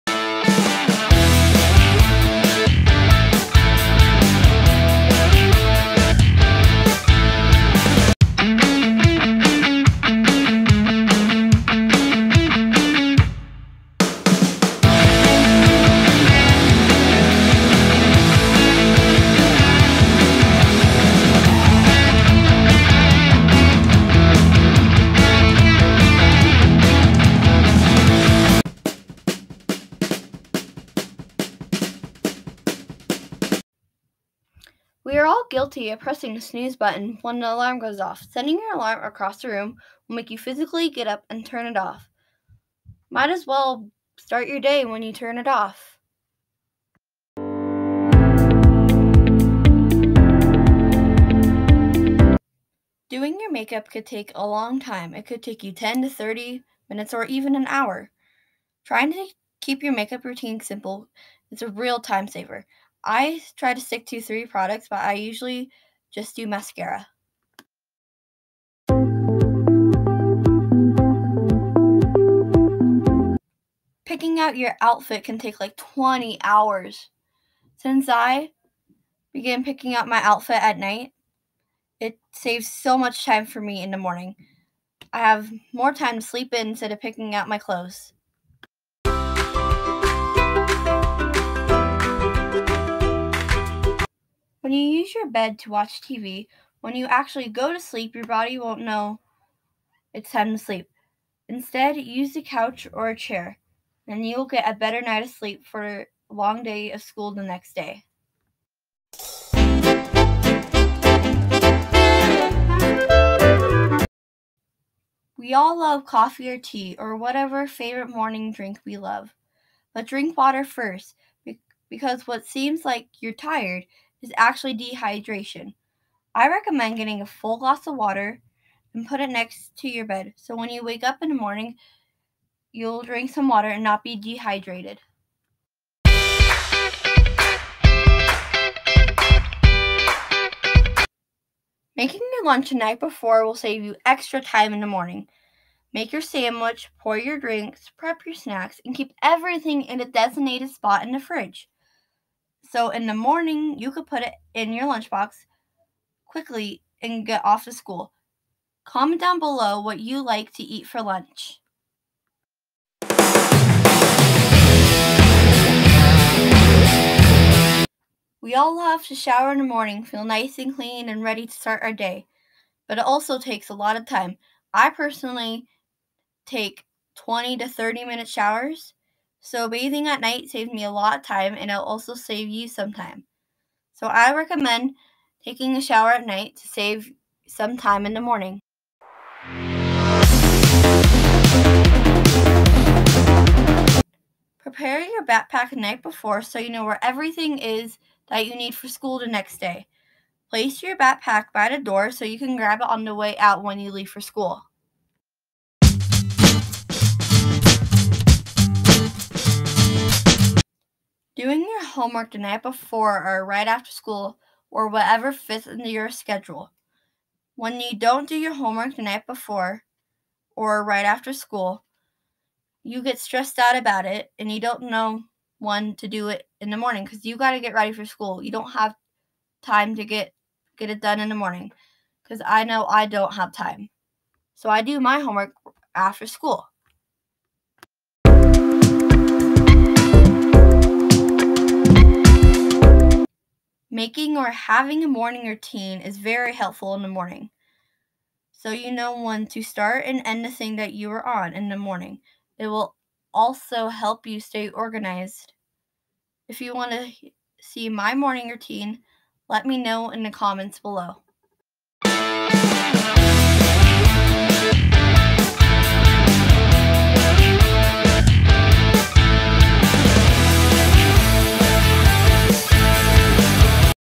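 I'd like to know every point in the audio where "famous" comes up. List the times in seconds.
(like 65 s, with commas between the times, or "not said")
not said.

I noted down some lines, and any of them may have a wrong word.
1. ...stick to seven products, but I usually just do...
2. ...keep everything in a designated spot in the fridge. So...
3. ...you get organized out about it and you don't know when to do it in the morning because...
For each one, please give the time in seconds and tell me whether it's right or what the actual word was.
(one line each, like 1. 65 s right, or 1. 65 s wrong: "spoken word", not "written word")
1. 63 s wrong: "three", not "seven"
2. 148 s right
3. 222 s wrong: "stressed", not "organized".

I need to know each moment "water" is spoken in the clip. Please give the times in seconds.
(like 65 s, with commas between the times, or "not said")
120 s, 127 s, 133 s.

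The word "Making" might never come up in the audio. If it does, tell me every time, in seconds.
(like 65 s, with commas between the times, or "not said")
141 s, 244 s.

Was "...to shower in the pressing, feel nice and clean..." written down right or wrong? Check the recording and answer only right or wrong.
wrong.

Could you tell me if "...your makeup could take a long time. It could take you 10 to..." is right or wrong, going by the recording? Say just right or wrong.
right.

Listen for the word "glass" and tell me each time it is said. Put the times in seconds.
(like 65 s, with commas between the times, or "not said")
127 s.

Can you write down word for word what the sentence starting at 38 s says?
Sending your alarm across the room will make you physically get up and turn it off.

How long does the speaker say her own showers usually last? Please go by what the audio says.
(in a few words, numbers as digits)
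20 to 30 minutes.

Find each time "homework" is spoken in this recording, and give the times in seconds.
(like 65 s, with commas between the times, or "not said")
211 s, 218 s, 235 s.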